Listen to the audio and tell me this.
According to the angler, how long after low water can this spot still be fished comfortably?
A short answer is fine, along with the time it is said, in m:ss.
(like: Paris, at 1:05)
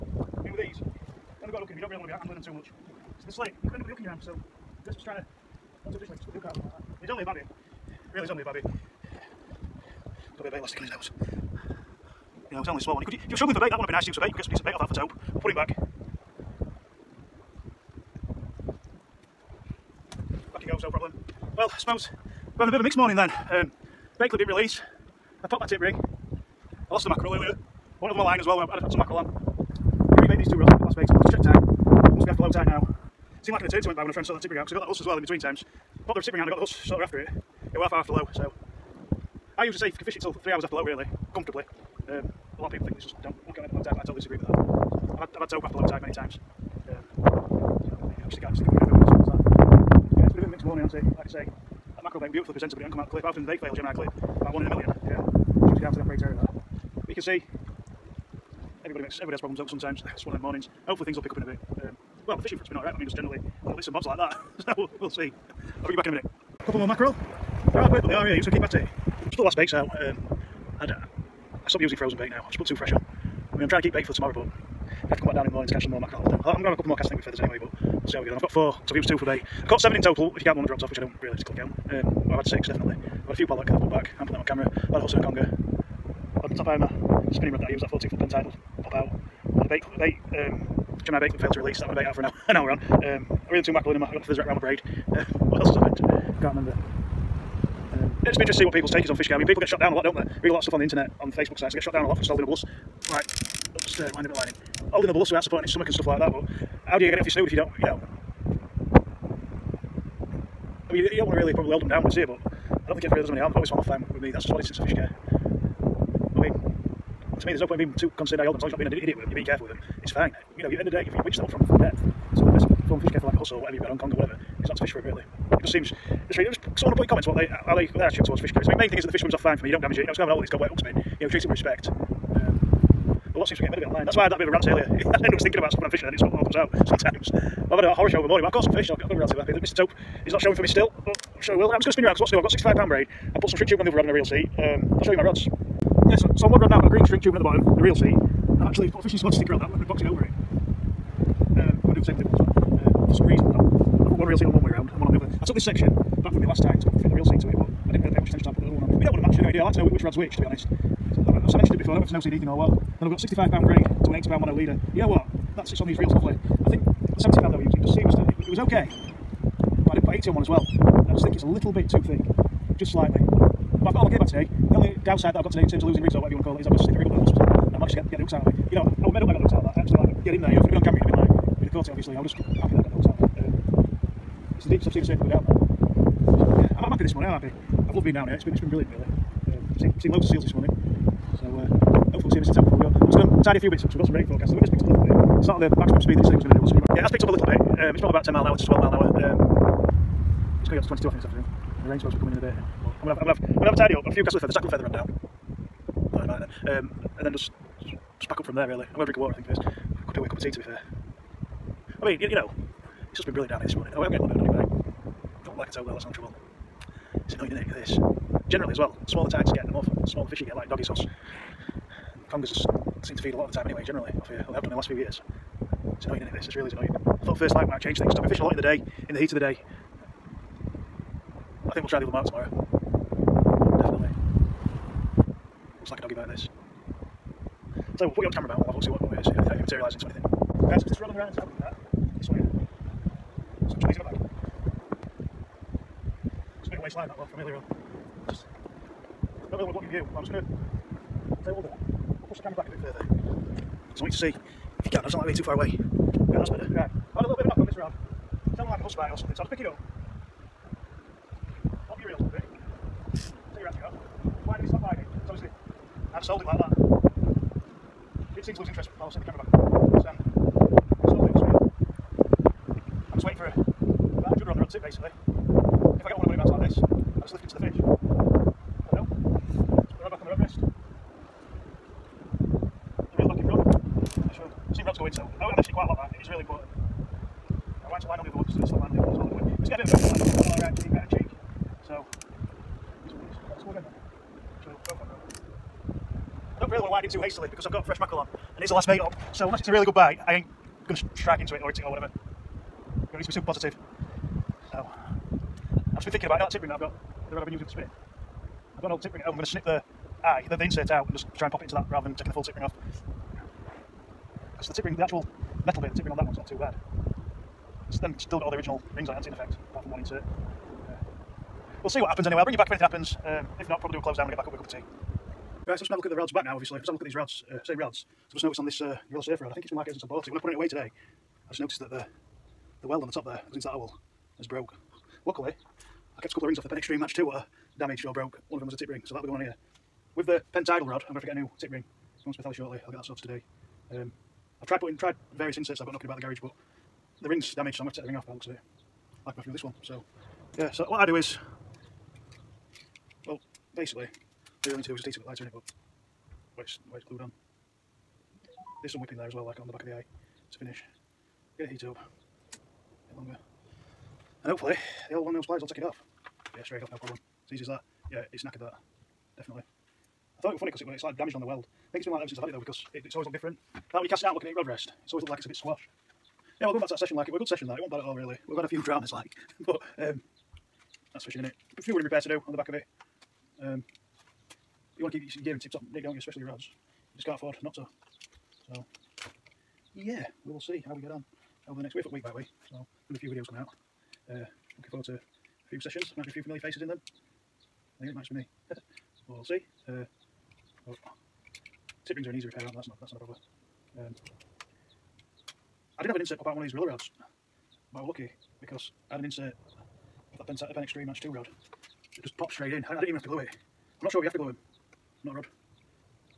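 3 hours, at 0:40.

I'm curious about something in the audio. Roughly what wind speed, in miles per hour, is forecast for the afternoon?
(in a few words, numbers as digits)
22.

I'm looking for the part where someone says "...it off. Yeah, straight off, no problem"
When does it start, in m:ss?
6:05.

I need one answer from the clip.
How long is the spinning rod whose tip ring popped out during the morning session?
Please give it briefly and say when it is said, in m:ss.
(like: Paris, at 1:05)
14 foot, at 1:27.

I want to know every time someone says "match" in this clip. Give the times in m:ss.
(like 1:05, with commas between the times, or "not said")
2:39, 5:36, 6:51.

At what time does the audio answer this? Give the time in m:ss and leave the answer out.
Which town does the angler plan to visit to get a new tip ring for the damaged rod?
5:42.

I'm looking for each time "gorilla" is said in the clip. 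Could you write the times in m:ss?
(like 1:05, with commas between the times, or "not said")
5:29, 6:46.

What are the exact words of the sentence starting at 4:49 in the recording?
Just get a bit of both line on right cheek, right uh, and cheek.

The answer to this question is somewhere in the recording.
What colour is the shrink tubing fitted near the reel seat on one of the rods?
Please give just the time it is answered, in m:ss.
2:26.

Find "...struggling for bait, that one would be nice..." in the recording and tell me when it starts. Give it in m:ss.
0:13.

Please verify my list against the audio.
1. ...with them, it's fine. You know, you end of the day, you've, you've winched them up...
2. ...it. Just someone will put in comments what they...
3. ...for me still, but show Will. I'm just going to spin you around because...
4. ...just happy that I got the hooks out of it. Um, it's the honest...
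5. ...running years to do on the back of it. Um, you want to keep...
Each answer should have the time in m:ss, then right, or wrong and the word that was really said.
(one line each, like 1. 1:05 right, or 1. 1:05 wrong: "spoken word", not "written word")
1. 1:59 right
2. 2:06 right
3. 2:20 right
4. 3:02 wrong: "deepest", not "honest"
5. 6:21 wrong: "repairs", not "years".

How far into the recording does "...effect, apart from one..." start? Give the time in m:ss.
5:19.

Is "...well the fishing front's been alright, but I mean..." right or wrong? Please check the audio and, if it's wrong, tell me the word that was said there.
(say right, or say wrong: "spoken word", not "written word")
right.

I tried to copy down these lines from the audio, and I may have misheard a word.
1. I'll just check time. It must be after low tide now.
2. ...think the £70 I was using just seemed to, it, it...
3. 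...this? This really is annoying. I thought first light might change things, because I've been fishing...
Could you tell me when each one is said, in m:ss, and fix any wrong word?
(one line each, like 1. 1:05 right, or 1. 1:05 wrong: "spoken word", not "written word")
1. 0:31 right
2. 2:46 right
3. 3:46 right.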